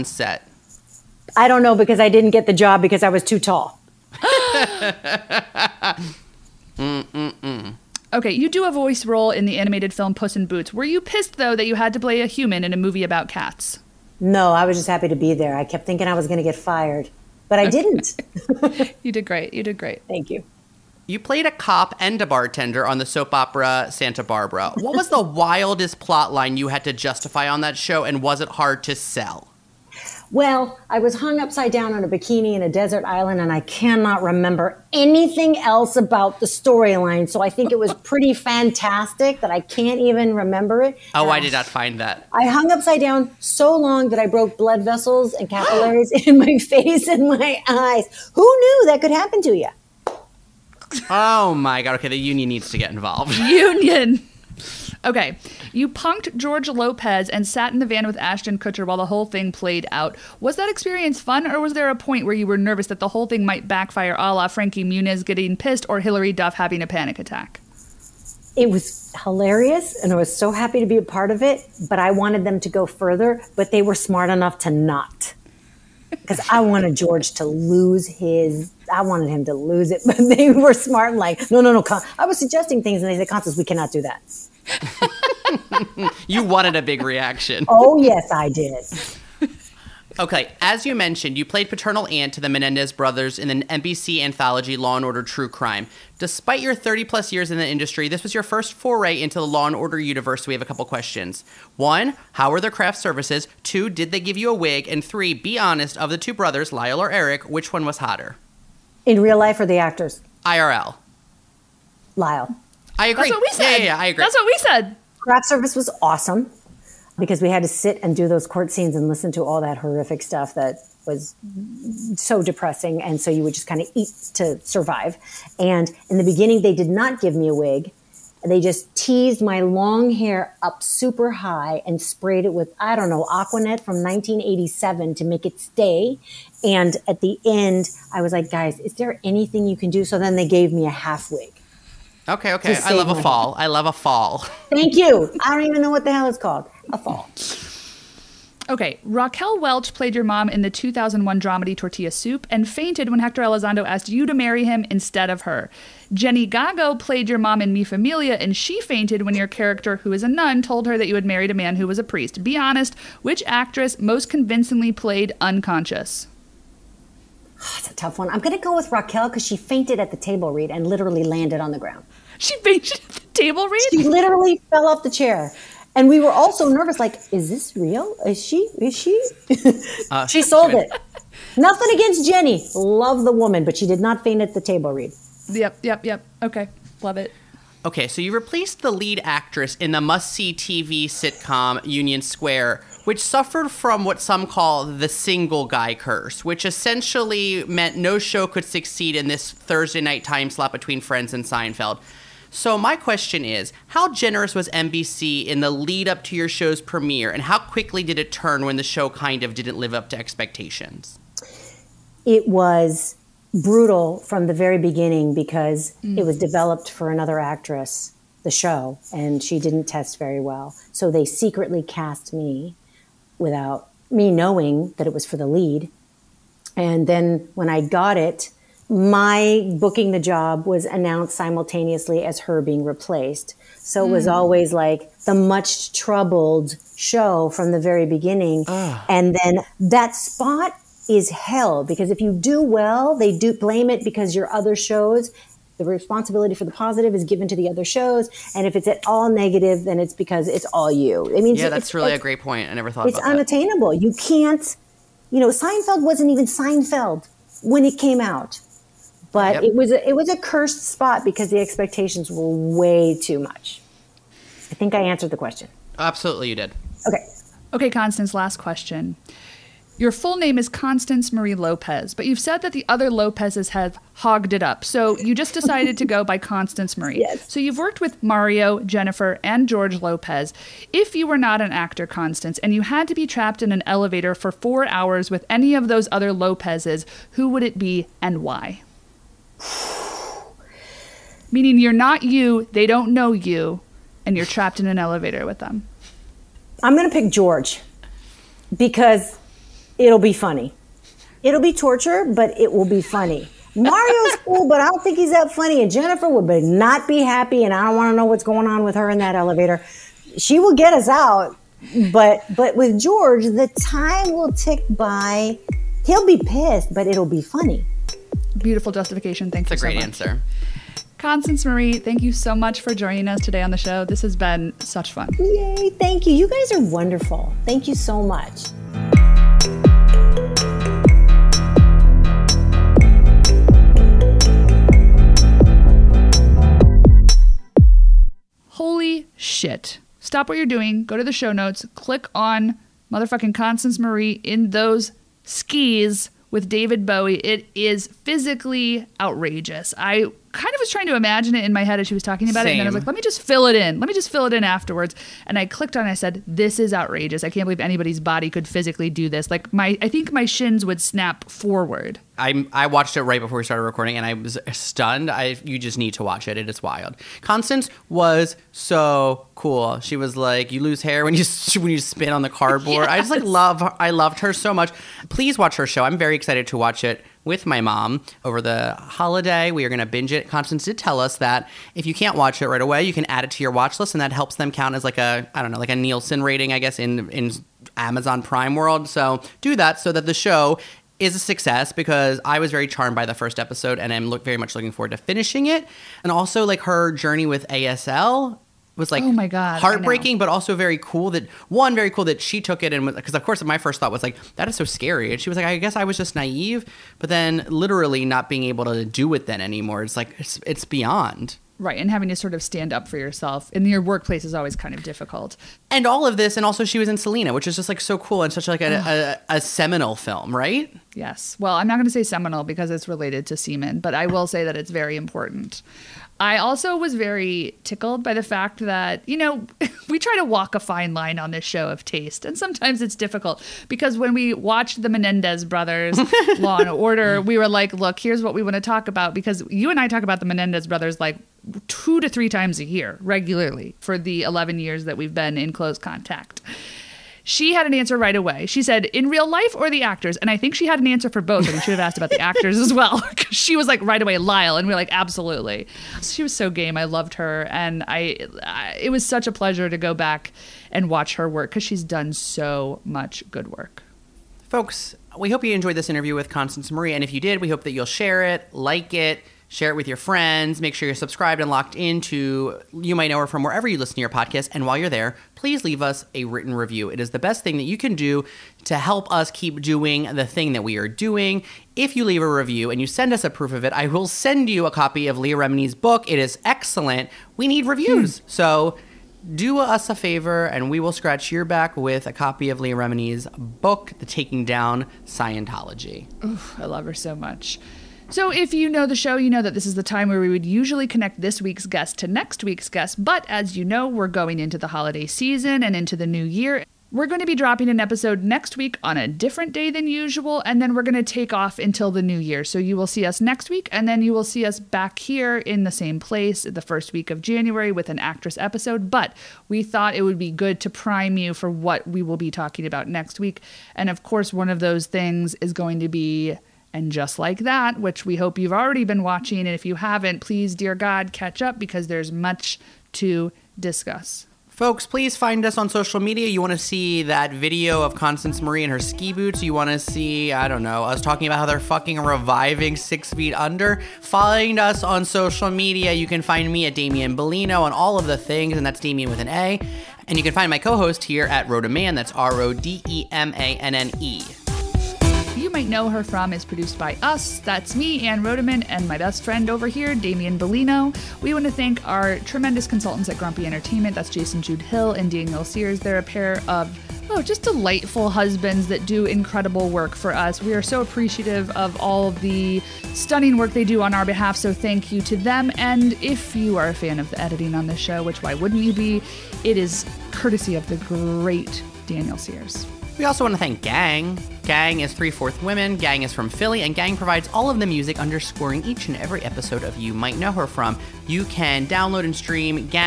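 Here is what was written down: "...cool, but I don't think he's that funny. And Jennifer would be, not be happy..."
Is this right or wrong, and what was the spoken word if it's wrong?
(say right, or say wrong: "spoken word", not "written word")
right.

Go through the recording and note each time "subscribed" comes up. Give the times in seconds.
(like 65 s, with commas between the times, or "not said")
471 s.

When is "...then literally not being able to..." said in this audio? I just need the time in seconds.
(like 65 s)
407 s.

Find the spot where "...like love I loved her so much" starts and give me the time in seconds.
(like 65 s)
373 s.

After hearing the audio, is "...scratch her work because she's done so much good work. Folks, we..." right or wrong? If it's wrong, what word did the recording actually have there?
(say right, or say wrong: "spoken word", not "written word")
wrong: "watch", not "scratch".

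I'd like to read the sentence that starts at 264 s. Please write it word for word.
I think I answered the question.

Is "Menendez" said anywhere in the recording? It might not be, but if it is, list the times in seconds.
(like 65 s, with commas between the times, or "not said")
92 s, 435 s, 440 s.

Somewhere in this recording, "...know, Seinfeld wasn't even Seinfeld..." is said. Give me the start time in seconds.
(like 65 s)
255 s.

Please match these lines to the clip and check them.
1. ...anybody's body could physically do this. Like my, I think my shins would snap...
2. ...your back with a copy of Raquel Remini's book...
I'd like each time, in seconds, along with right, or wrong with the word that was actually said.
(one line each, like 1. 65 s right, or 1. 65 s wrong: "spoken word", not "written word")
1. 357 s right
2. 491 s wrong: "Leah", not "Raquel".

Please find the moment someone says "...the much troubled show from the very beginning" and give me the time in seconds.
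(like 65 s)
235 s.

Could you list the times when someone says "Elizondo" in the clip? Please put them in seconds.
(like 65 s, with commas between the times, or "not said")
153 s.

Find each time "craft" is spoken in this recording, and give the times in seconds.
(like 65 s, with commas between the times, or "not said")
102 s, 115 s.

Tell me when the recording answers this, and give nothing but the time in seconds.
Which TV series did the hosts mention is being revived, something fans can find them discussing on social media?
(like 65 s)
542 s.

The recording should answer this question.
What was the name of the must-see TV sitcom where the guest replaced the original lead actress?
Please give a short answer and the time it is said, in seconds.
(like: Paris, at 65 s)
Union Square, at 191 s.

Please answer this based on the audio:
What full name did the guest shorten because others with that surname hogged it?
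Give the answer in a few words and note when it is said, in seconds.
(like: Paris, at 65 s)
Constance Marie Lopez, at 270 s.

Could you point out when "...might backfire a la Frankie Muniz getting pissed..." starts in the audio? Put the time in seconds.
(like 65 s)
63 s.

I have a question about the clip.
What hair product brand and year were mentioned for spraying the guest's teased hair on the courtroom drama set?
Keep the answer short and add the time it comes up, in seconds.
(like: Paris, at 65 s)
Aqua Net from 1987, at 133 s.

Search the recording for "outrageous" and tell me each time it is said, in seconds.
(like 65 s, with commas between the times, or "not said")
349 s, 356 s.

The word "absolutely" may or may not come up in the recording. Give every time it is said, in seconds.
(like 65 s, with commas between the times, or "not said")
265 s, 455 s.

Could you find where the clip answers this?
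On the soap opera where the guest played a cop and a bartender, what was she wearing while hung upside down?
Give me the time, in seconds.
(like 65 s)
32 s.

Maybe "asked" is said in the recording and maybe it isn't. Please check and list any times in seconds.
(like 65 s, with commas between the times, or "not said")
153 s, 452 s.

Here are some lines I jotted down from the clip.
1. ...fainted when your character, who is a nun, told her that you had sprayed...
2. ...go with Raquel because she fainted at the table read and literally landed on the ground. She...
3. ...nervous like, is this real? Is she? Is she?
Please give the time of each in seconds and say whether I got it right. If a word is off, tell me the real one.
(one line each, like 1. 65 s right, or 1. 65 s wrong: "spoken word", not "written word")
1. 158 s wrong: "married", not "sprayed"
2. 168 s right
3. 176 s right.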